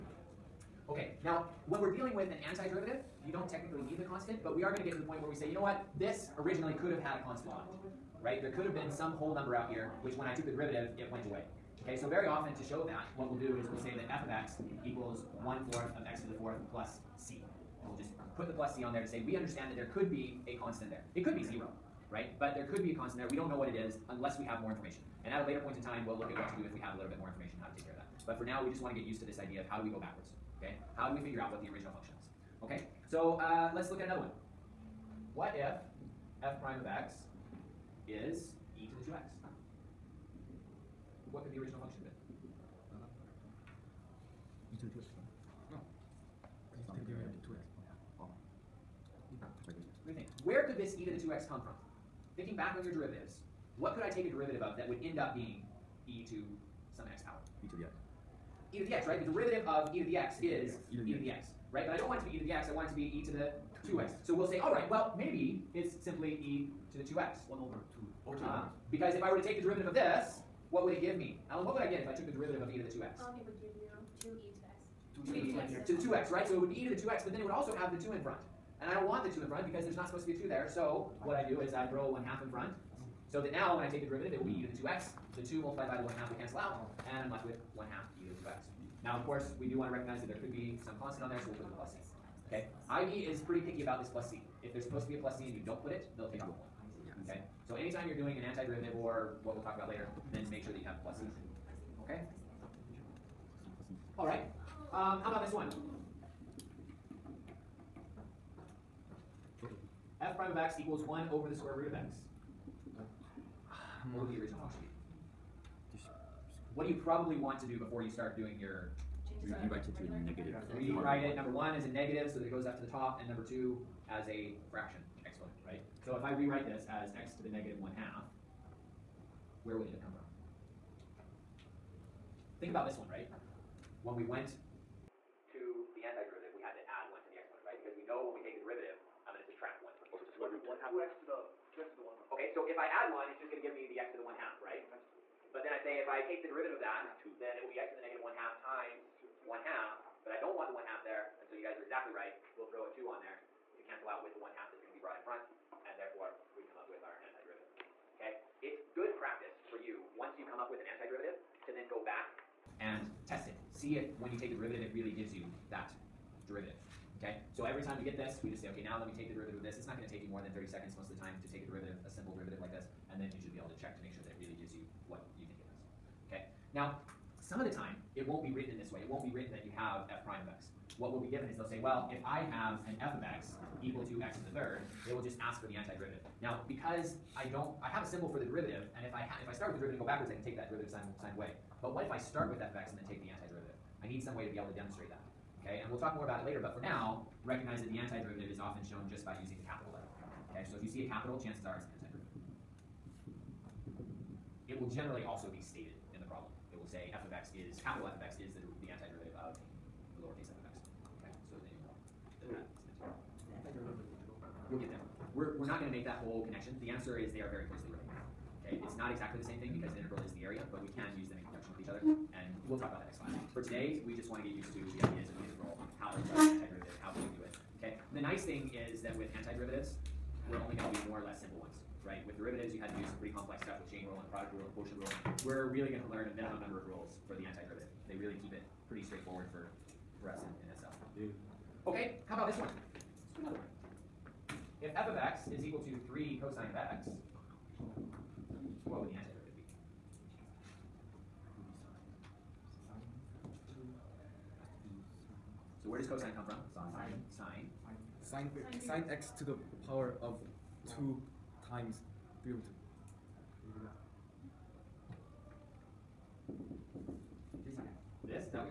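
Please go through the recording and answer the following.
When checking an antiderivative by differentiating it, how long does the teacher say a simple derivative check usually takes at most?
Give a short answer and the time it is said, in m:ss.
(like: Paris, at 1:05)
30 seconds, at 2:50.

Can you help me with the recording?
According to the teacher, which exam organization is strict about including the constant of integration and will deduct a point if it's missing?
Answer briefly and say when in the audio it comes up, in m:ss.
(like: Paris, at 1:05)
IB, at 1:32.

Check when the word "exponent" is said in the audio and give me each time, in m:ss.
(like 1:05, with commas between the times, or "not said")
2:17.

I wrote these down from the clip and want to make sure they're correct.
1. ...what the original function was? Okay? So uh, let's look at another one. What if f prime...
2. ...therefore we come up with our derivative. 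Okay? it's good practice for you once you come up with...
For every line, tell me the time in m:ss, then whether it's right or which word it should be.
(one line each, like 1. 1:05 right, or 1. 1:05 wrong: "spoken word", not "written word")
1. 0:31 right
2. 2:35 wrong: "antiderivative", not "derivative".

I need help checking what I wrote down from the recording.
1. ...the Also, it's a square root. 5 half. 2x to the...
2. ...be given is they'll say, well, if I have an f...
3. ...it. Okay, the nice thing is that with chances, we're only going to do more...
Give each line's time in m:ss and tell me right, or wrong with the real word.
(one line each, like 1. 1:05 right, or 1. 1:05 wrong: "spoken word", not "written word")
1. 2:20 wrong: "1", not "5"
2. 3:01 right
3. 3:47 wrong: "antiderivatives", not "chances".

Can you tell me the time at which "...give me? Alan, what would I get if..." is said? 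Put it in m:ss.
1:11.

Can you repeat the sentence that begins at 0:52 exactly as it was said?
Thinking back on your derivatives, what could I take a derivative of that would end up being e to some x power?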